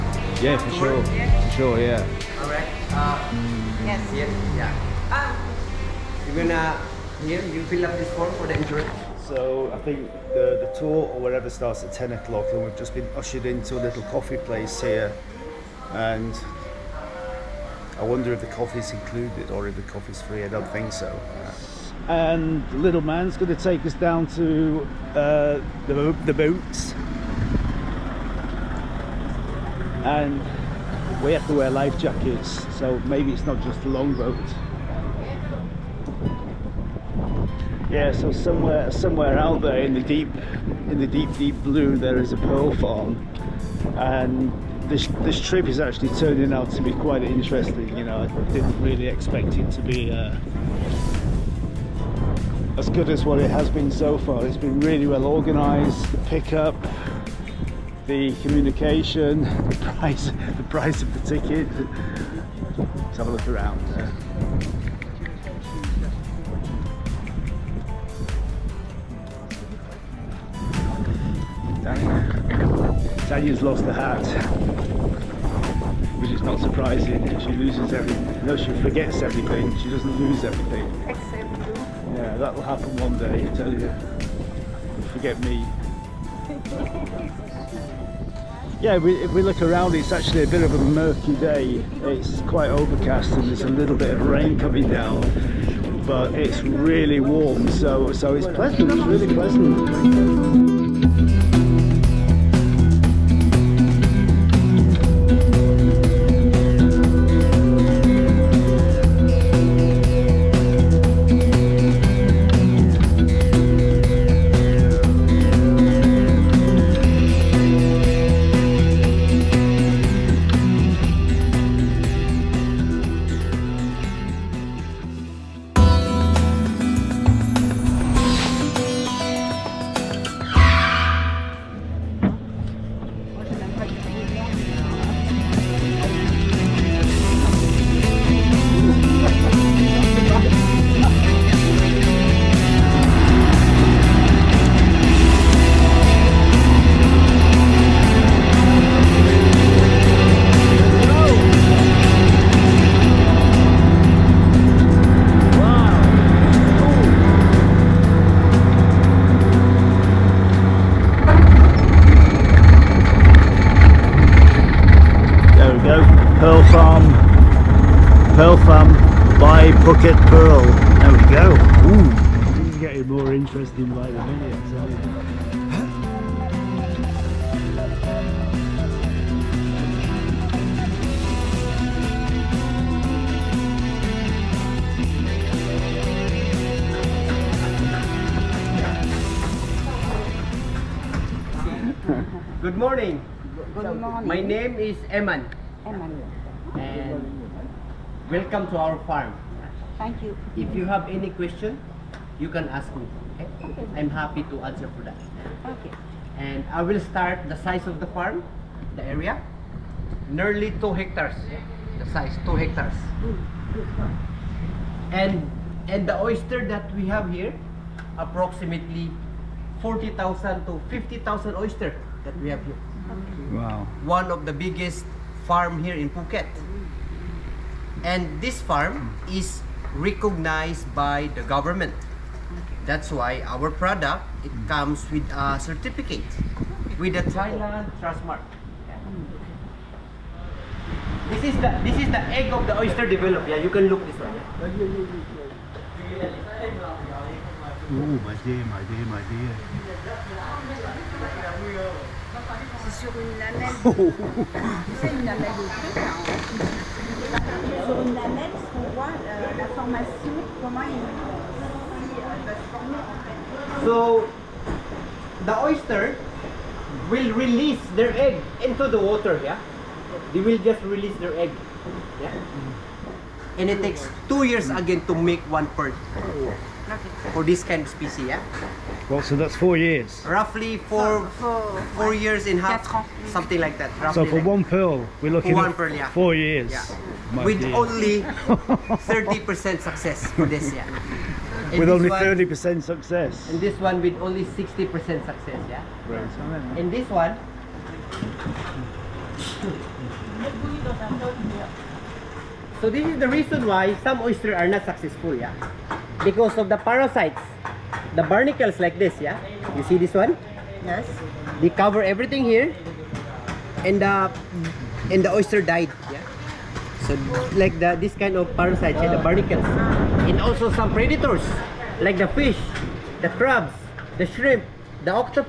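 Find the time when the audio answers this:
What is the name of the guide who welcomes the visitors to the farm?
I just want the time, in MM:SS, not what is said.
03:14.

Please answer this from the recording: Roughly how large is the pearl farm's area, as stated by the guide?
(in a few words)
2 hectares.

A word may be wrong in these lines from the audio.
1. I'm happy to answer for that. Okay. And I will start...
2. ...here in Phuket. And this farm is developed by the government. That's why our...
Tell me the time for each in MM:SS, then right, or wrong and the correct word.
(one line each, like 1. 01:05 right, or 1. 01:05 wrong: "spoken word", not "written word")
1. 03:23 right
2. 03:45 wrong: "recognized", not "developed".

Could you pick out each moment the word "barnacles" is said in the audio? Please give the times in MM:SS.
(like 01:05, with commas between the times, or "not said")
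05:08, 05:19.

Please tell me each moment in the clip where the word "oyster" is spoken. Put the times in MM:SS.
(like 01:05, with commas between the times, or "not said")
03:36, 03:41, 04:02, 04:25, 05:04, 05:15.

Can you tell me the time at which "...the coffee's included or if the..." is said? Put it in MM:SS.
00:18.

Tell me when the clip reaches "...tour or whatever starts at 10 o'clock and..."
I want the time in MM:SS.
00:10.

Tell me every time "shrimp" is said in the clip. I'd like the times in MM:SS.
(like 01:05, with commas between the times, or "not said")
05:24.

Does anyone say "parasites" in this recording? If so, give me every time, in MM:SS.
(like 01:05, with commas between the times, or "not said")
05:06, 05:18.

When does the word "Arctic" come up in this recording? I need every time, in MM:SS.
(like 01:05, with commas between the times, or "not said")
not said.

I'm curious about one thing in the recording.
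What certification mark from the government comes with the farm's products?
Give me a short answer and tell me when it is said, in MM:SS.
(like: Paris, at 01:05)
Thailand Trustmark, at 03:57.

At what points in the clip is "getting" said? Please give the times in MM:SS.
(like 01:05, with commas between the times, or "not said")
not said.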